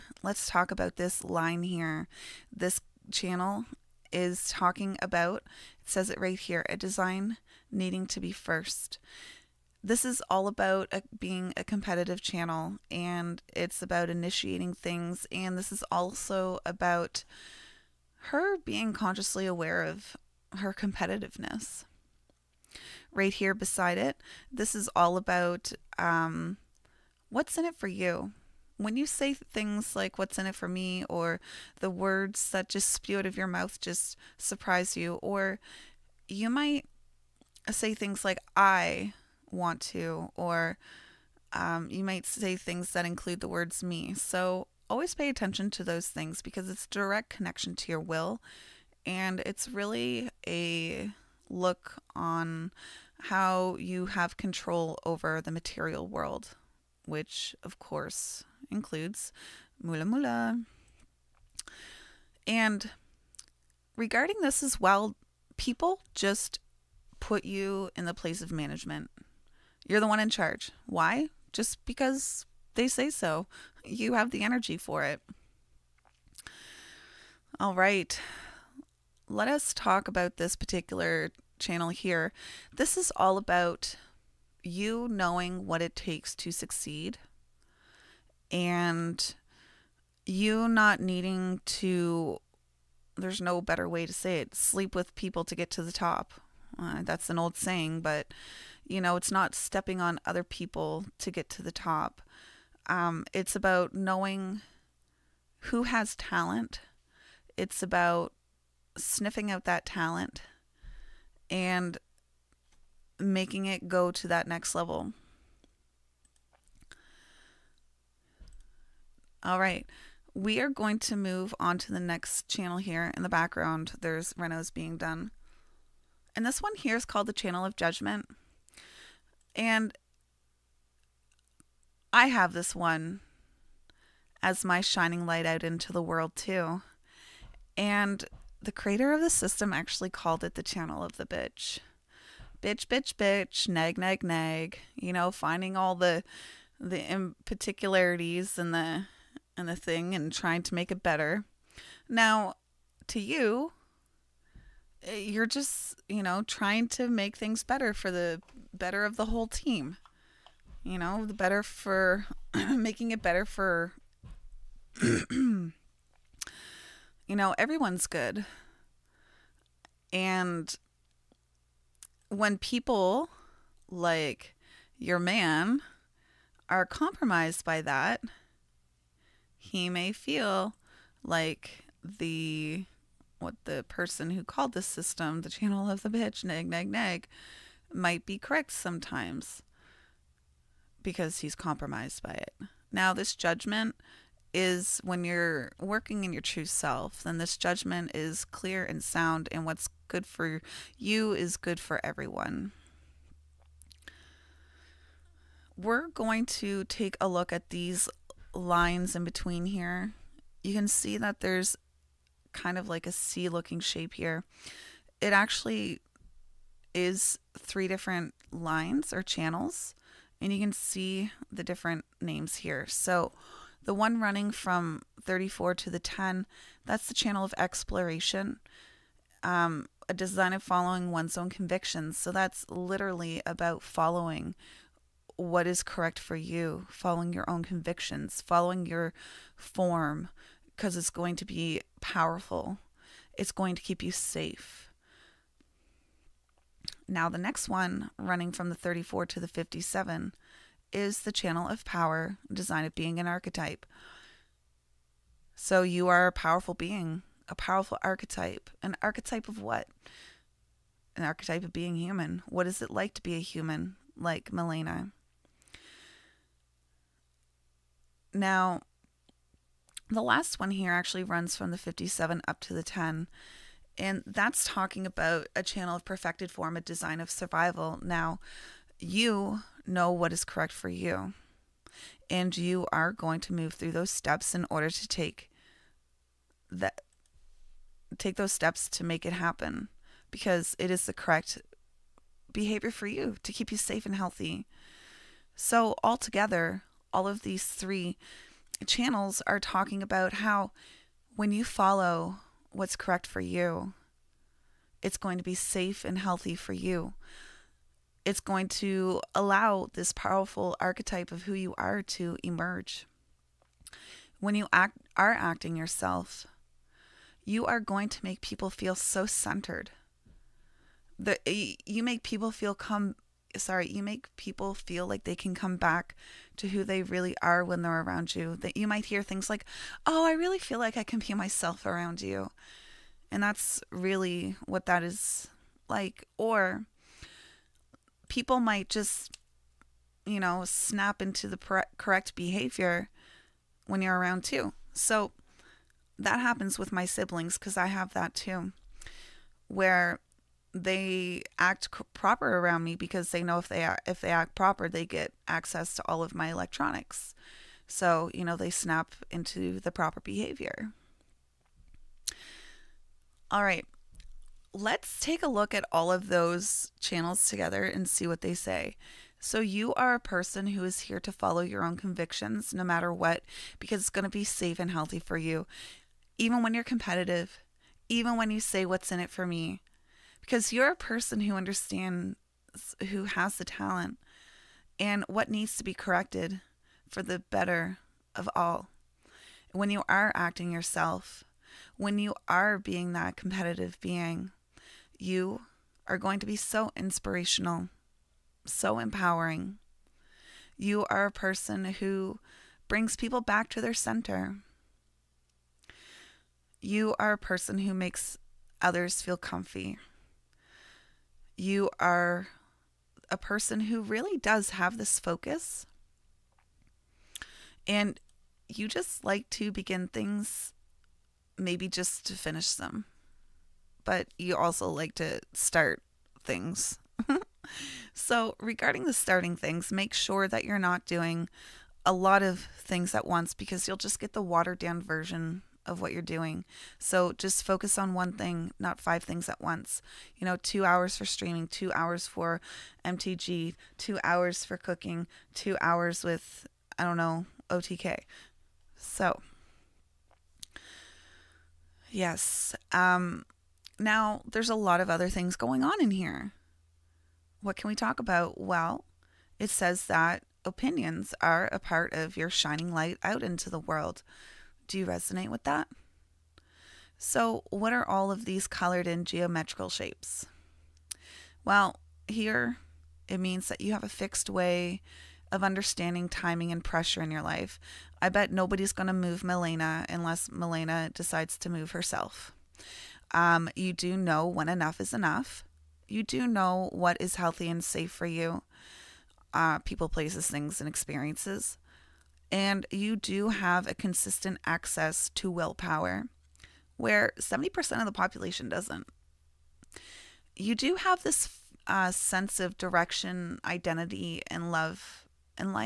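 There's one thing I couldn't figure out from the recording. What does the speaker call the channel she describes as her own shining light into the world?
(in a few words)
Channel of Judgment.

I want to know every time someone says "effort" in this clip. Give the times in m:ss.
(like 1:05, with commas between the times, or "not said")
not said.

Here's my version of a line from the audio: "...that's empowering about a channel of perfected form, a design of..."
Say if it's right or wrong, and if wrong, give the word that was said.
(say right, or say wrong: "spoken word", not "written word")
wrong: "talking", not "empowering".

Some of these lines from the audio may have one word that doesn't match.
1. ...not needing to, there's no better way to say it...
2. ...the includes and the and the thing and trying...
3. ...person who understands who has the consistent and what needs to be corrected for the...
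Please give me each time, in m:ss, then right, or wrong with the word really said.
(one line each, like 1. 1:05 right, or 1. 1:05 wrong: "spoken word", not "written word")
1. 1:30 right
2. 2:26 wrong: "particularities", not "includes"
3. 6:20 wrong: "talent", not "consistent".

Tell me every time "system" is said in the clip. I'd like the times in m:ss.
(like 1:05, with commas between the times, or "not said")
2:19, 3:04.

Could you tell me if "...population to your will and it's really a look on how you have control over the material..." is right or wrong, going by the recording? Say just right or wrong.
wrong.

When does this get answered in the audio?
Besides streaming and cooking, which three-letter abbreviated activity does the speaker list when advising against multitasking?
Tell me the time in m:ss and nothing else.
7:23.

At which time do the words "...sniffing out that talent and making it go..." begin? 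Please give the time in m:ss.
1:48.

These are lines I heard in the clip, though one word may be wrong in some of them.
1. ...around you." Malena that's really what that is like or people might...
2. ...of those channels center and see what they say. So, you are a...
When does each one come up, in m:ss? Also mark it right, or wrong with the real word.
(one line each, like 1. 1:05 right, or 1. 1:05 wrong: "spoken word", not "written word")
1. 5:31 wrong: "And", not "Malena"
2. 6:06 wrong: "together", not "center".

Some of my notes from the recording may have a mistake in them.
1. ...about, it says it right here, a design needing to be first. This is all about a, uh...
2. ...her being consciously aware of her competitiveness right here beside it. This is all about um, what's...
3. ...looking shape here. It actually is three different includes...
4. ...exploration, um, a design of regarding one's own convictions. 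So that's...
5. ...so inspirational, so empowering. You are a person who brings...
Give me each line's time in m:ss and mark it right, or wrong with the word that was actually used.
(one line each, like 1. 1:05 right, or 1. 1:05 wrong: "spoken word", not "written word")
1. 0:05 right
2. 0:18 right
3. 3:33 wrong: "lines", not "includes"
4. 3:47 wrong: "following", not "regarding"
5. 6:36 right.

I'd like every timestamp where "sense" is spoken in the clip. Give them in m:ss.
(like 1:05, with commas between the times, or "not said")
8:22.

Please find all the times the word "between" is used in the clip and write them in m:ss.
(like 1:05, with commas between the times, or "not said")
3:29.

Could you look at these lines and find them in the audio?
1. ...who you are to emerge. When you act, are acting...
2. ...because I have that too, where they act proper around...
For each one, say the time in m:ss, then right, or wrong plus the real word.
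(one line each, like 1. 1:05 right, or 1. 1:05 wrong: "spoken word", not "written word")
1. 5:11 right
2. 5:47 right.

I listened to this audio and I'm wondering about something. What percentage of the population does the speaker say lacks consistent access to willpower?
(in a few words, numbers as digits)
70%.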